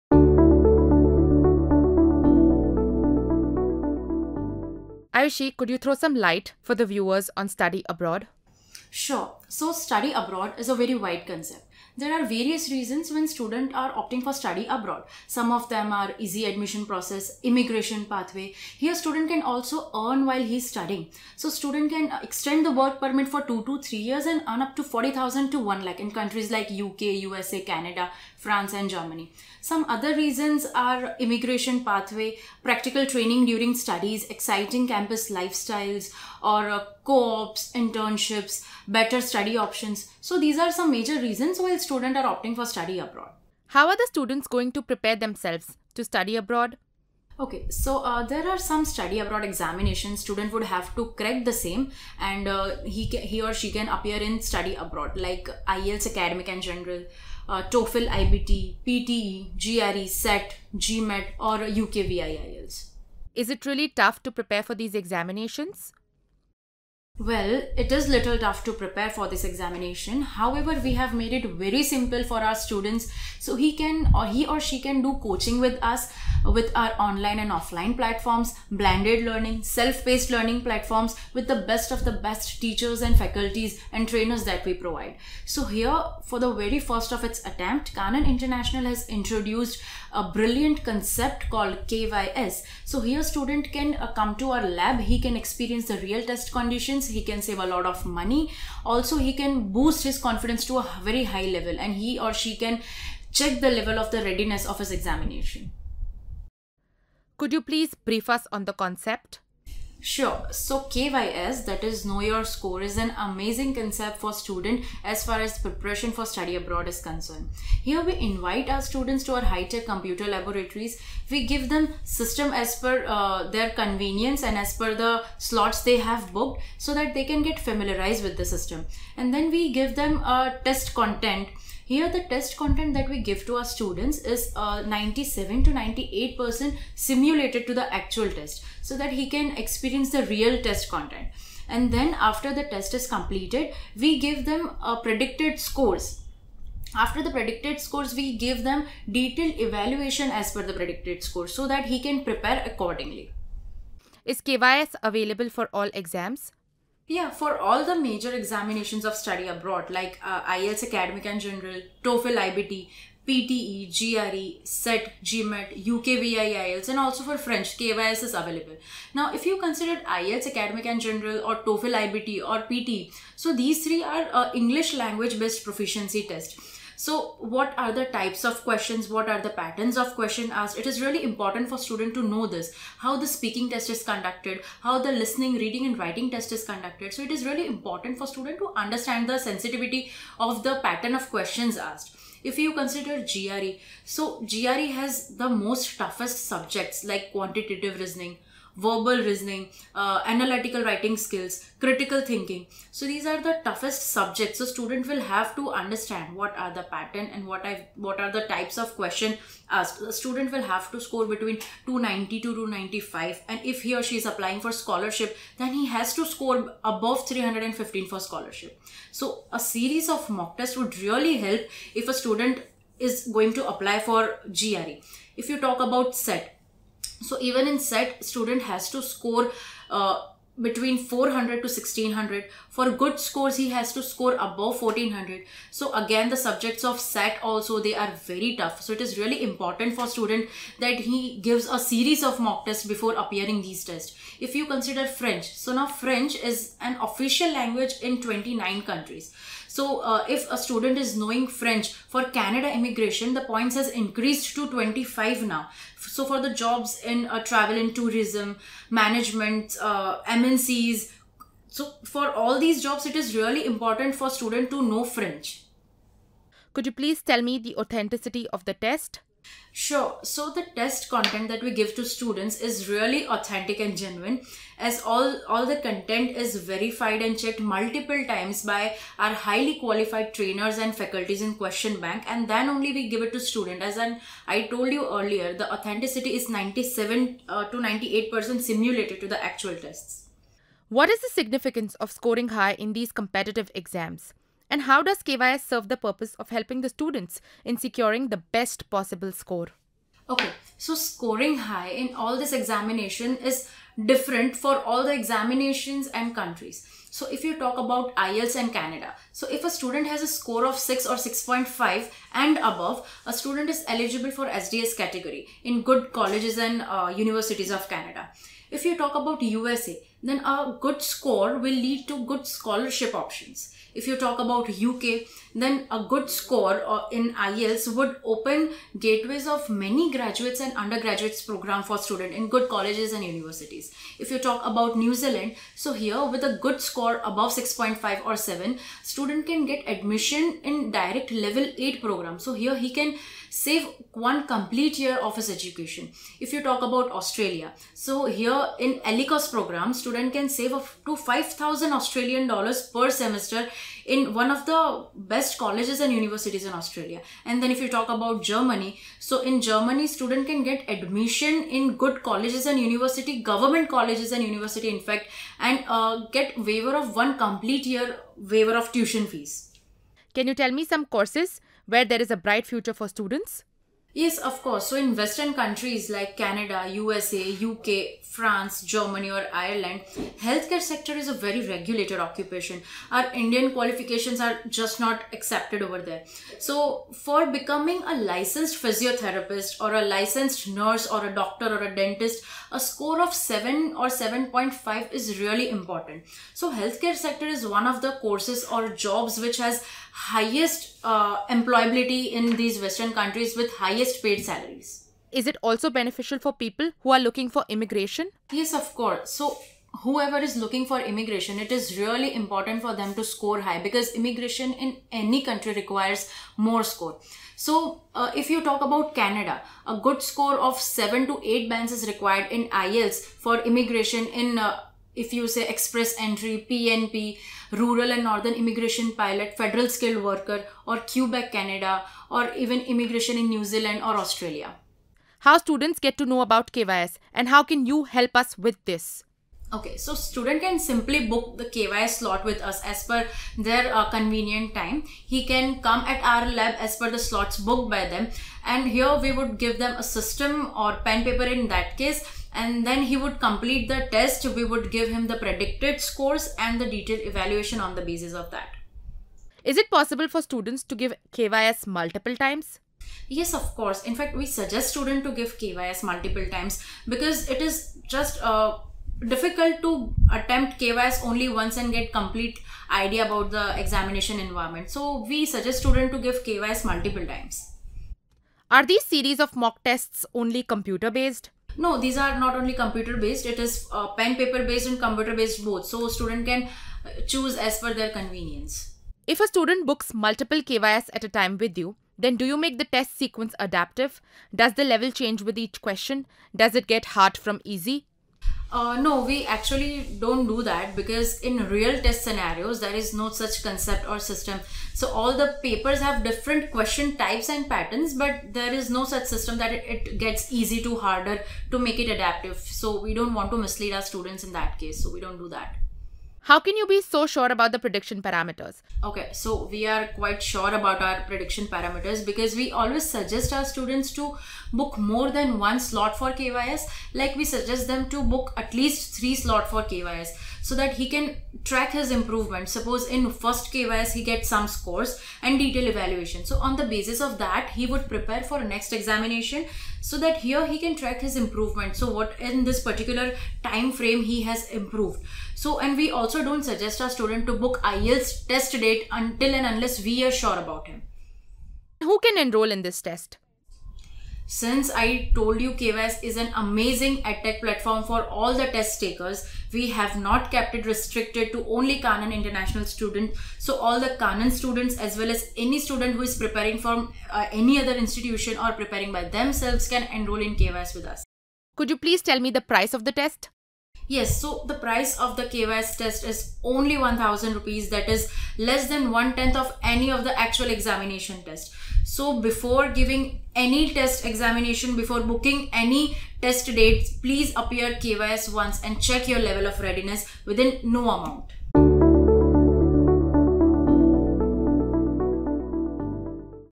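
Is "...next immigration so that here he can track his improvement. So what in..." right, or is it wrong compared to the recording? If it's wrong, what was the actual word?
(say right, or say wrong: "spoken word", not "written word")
wrong: "examination", not "immigration".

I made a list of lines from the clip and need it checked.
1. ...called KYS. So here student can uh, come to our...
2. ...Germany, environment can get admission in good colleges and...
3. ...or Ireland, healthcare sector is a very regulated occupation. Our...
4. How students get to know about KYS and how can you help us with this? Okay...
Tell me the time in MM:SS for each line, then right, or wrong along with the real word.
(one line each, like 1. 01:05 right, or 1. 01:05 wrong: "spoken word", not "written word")
1. 01:31 right
2. 05:59 wrong: "student", not "environment"
3. 06:19 right
4. 07:15 right.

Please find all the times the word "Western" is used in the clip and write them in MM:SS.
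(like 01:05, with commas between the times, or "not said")
06:15, 06:42.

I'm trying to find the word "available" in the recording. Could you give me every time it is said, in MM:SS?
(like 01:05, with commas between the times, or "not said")
02:35, 02:48.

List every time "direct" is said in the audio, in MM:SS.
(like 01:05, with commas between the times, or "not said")
05:40.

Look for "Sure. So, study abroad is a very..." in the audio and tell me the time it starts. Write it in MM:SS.
00:08.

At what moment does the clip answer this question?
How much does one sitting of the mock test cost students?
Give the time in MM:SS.
09:36.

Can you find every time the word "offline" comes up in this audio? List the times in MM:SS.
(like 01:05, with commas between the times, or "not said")
01:17.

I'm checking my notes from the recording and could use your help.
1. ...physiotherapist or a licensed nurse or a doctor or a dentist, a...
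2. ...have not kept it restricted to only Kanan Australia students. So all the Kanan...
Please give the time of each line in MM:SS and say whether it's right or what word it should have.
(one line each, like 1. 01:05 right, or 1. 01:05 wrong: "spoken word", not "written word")
1. 06:28 right
2. 09:19 wrong: "International", not "Australia".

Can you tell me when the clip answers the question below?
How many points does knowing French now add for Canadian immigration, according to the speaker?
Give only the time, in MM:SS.
04:14.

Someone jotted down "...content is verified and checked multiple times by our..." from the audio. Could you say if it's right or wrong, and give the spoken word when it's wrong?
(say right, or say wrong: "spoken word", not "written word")
right.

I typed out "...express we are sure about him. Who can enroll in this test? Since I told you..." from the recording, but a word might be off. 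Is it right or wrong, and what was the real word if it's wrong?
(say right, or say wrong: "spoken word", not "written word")
wrong: "unless", not "express".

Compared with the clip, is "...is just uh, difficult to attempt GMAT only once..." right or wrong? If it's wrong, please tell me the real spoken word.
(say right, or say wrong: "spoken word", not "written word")
wrong: "KYS", not "GMAT".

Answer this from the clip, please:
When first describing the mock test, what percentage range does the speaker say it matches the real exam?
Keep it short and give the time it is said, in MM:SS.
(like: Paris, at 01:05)
97 to 98%, at 02:14.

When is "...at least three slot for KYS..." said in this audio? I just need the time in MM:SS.
08:48.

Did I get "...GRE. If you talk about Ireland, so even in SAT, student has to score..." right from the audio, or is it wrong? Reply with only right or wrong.
wrong.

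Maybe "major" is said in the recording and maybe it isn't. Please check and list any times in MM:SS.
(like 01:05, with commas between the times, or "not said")
00:40, 02:37.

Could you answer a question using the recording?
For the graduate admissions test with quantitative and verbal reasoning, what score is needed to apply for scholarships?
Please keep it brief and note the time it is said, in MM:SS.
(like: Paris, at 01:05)
above 315, at 03:36.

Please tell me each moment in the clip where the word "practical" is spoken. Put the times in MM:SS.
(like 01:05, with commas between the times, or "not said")
00:32.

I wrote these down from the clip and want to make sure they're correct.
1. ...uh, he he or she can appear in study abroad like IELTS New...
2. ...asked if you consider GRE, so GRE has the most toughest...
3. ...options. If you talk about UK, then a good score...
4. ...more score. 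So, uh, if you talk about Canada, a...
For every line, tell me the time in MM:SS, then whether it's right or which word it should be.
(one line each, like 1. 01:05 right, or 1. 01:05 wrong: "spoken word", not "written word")
1. 00:52 wrong: "Academic", not "New"
2. 03:11 right
3. 05:23 right
4. 06:56 right.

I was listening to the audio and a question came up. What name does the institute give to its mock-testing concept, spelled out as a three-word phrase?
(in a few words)
Know Your Score.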